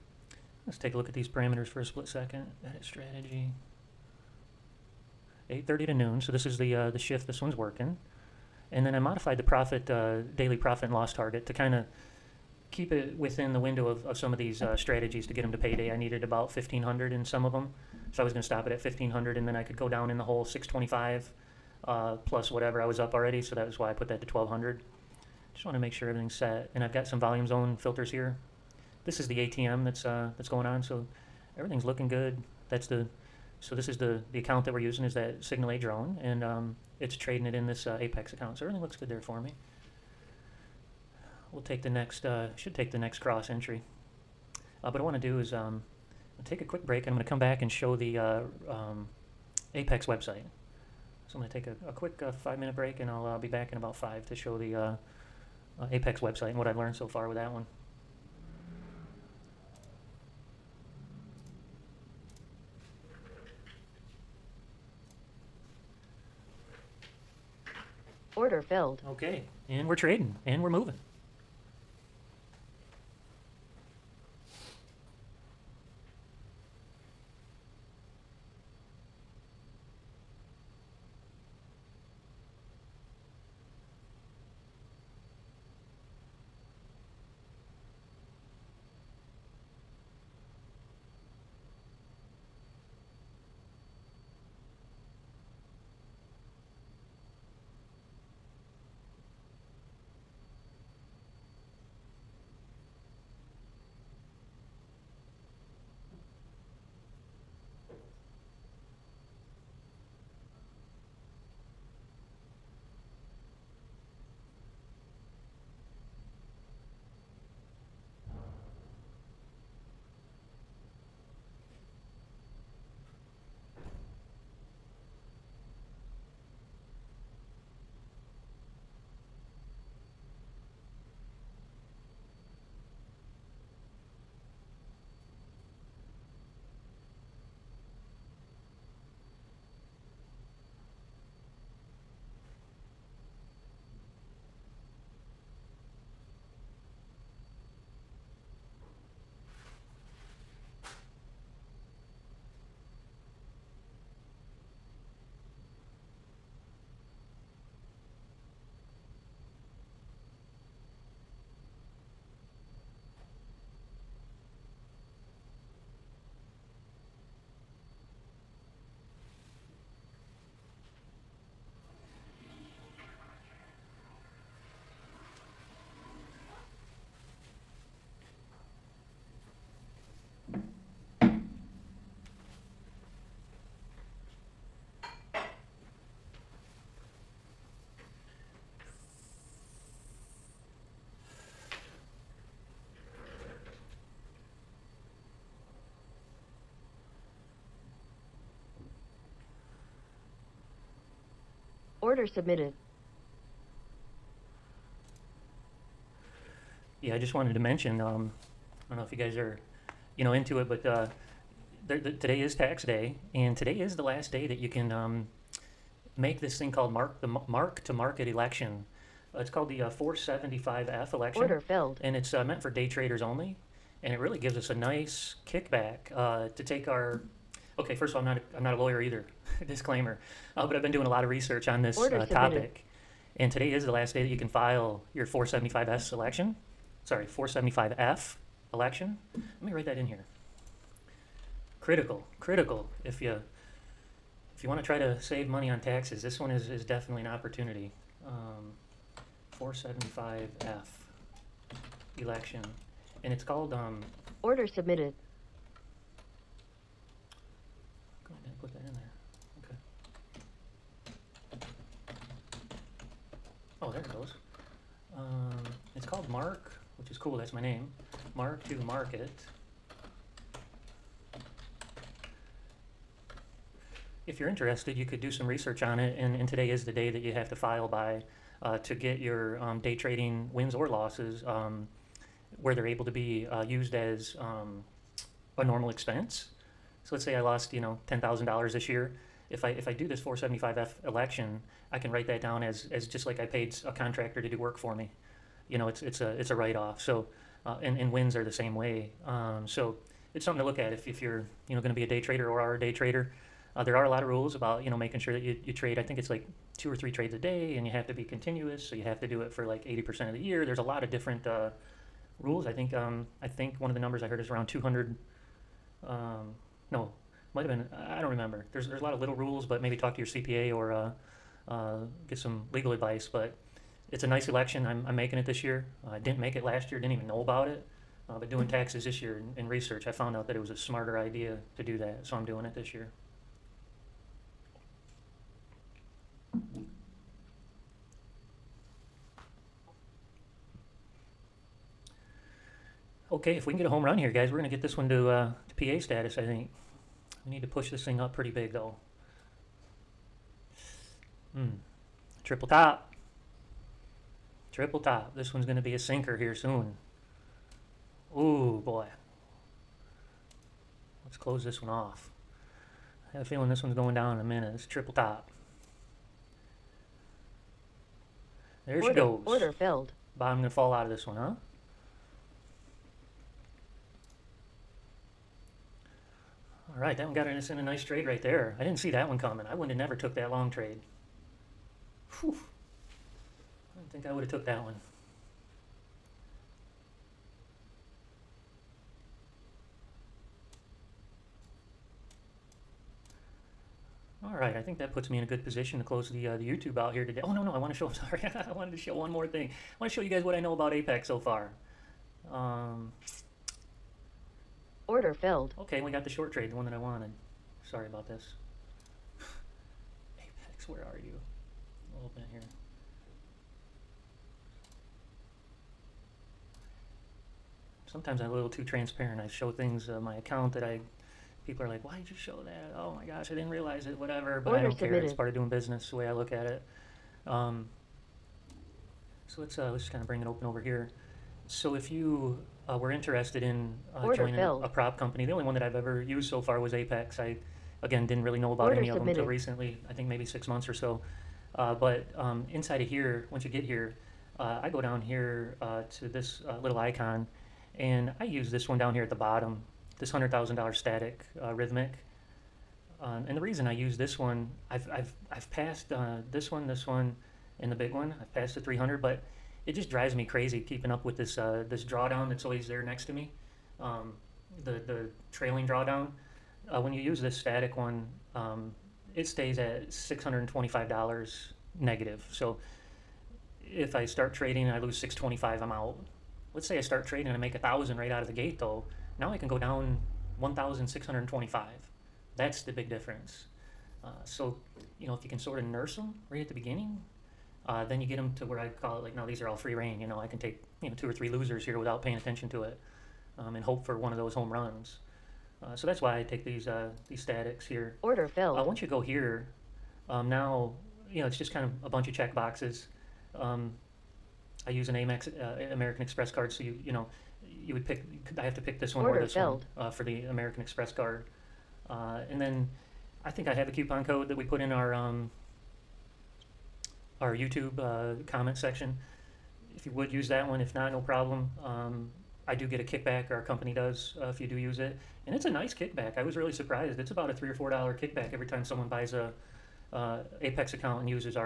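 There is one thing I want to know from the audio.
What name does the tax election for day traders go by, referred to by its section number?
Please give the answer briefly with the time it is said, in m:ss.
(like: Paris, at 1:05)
475F election, at 3:39.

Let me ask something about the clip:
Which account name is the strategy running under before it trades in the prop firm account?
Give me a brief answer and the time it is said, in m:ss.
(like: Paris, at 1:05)
Signal A drone, at 0:35.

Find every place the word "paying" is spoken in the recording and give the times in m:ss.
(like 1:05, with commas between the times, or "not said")
8:12.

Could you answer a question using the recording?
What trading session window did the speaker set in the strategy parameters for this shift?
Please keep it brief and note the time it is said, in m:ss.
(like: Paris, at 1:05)
8:30 to noon, at 0:05.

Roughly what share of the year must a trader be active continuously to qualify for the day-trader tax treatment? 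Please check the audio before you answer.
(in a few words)
80%.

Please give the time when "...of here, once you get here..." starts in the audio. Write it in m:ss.
7:22.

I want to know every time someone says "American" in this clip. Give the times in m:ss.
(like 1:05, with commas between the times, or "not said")
8:25, 8:30.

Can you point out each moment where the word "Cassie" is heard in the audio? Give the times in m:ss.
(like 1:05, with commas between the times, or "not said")
not said.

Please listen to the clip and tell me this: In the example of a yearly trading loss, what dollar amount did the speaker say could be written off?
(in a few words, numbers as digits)
$10,000.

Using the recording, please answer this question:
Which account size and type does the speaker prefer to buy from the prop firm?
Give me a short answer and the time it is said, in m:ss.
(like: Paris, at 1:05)
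$100,000 static, at 7:30.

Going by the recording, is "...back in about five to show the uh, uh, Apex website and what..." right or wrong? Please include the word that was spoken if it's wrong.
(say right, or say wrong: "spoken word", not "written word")
right.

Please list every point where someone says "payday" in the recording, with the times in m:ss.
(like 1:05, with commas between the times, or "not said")
0:15.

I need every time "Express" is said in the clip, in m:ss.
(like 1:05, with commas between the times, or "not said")
8:26, 8:30.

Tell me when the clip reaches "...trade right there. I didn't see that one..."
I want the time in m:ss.
6:18.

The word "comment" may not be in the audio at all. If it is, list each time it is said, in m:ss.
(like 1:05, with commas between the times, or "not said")
8:38.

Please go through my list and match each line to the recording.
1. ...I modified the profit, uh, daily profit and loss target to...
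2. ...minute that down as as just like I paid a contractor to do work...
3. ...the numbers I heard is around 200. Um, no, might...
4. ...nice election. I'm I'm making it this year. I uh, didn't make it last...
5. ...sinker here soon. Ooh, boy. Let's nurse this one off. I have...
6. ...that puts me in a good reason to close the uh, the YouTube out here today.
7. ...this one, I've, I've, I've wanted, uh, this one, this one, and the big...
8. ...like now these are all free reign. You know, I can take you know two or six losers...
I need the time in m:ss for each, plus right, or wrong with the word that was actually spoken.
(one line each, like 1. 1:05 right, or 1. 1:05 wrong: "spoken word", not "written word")
1. 0:08 right
2. 4:52 wrong: "write", not "minute"
3. 5:13 right
4. 5:24 right
5. 5:55 wrong: "close", not "nurse"
6. 6:34 wrong: "position", not "reason"
7. 7:34 wrong: "passed", not "wanted"
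8. 8:09 wrong: "three", not "six".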